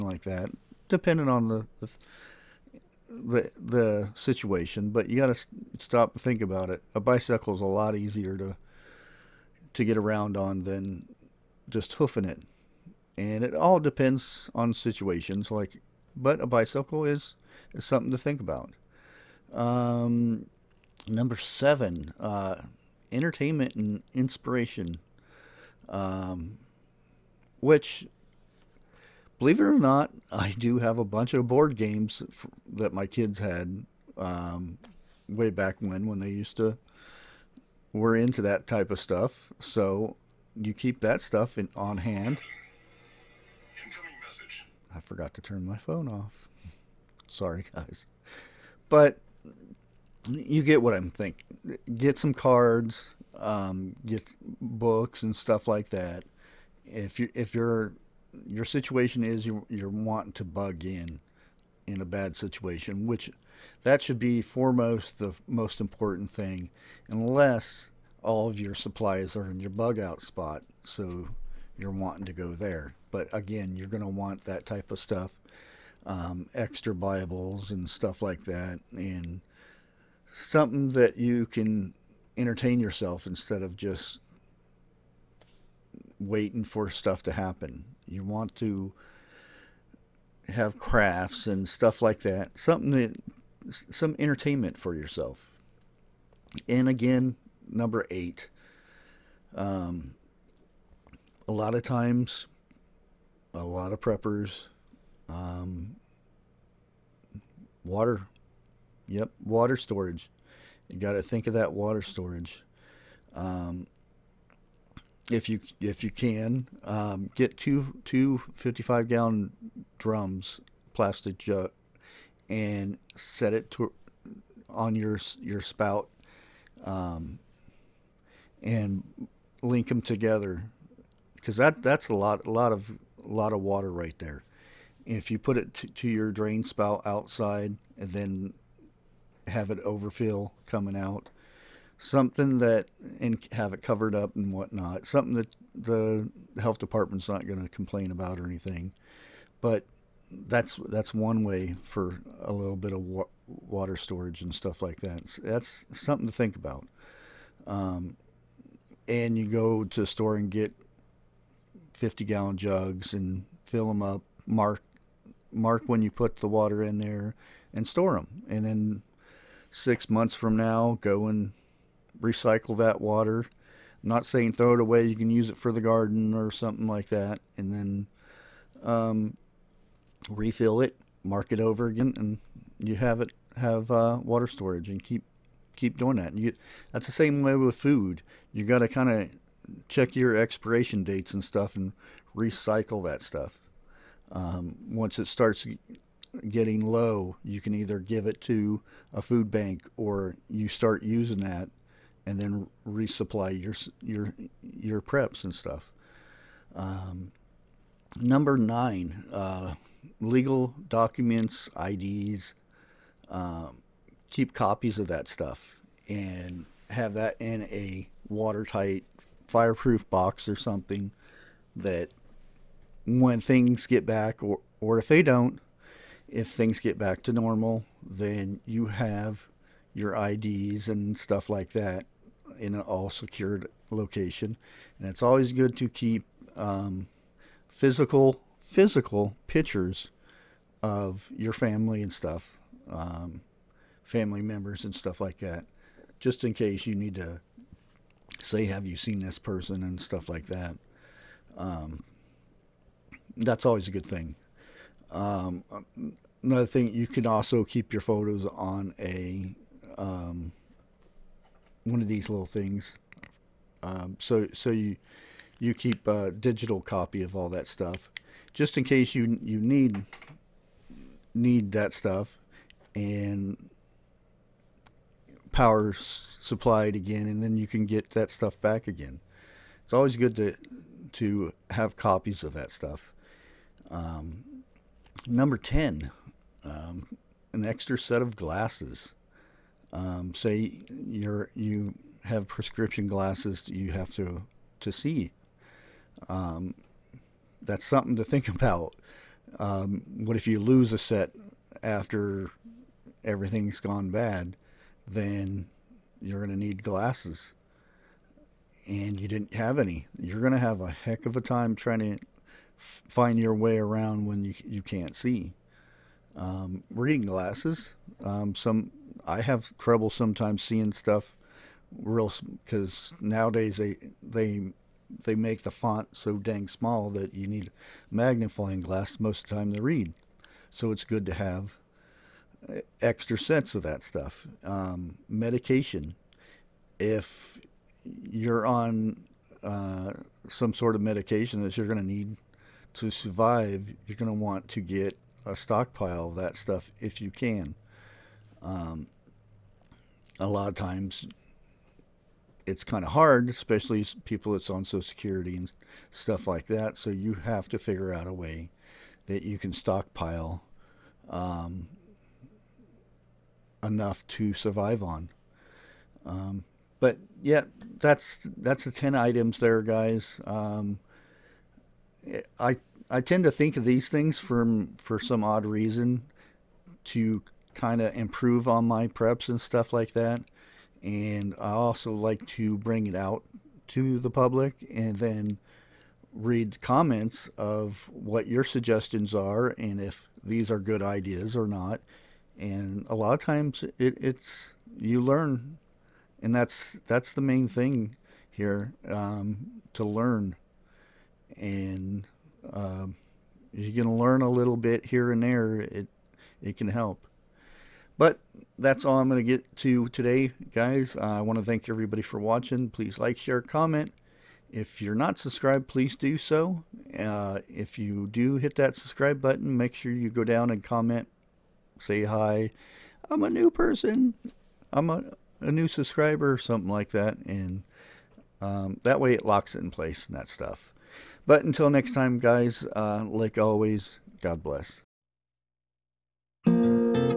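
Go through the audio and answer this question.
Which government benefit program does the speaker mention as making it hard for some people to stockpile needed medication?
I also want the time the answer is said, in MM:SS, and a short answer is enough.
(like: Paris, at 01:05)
Social Security, at 05:54.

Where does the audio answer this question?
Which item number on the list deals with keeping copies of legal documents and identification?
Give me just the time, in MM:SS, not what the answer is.
03:28.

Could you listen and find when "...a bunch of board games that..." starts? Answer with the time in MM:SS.
00:30.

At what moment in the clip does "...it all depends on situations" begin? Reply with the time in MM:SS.
00:13.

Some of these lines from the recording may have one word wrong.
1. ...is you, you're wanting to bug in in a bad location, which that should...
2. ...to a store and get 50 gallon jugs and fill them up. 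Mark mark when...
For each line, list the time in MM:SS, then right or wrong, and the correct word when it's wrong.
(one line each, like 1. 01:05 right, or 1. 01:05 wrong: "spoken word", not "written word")
1. 00:59 wrong: "situation", not "location"
2. 02:39 right.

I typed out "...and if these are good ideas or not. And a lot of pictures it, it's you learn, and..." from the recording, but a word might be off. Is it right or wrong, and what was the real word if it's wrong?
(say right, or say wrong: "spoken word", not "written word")
wrong: "times", not "pictures".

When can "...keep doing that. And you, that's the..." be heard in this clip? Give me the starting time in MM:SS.
03:05.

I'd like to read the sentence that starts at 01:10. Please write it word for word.
So you're wanting to go there.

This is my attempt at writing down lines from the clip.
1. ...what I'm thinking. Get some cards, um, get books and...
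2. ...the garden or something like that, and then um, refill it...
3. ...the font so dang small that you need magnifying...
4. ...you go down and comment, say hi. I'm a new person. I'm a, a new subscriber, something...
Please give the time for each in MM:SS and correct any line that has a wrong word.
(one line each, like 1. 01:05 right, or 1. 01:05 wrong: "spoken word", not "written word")
1. 00:50 right
2. 02:55 right
3. 05:25 right
4. 07:00 right.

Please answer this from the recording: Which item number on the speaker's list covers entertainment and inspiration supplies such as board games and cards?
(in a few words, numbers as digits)
7.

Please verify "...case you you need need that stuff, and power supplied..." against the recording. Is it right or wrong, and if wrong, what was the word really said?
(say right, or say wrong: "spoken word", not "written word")
right.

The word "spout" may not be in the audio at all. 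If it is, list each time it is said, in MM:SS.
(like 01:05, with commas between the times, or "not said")
02:05, 02:16.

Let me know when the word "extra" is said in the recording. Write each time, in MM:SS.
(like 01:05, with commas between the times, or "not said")
01:16, 04:47, 05:32.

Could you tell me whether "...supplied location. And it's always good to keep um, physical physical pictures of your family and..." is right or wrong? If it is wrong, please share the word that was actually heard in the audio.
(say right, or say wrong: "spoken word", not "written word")
wrong: "secured", not "supplied".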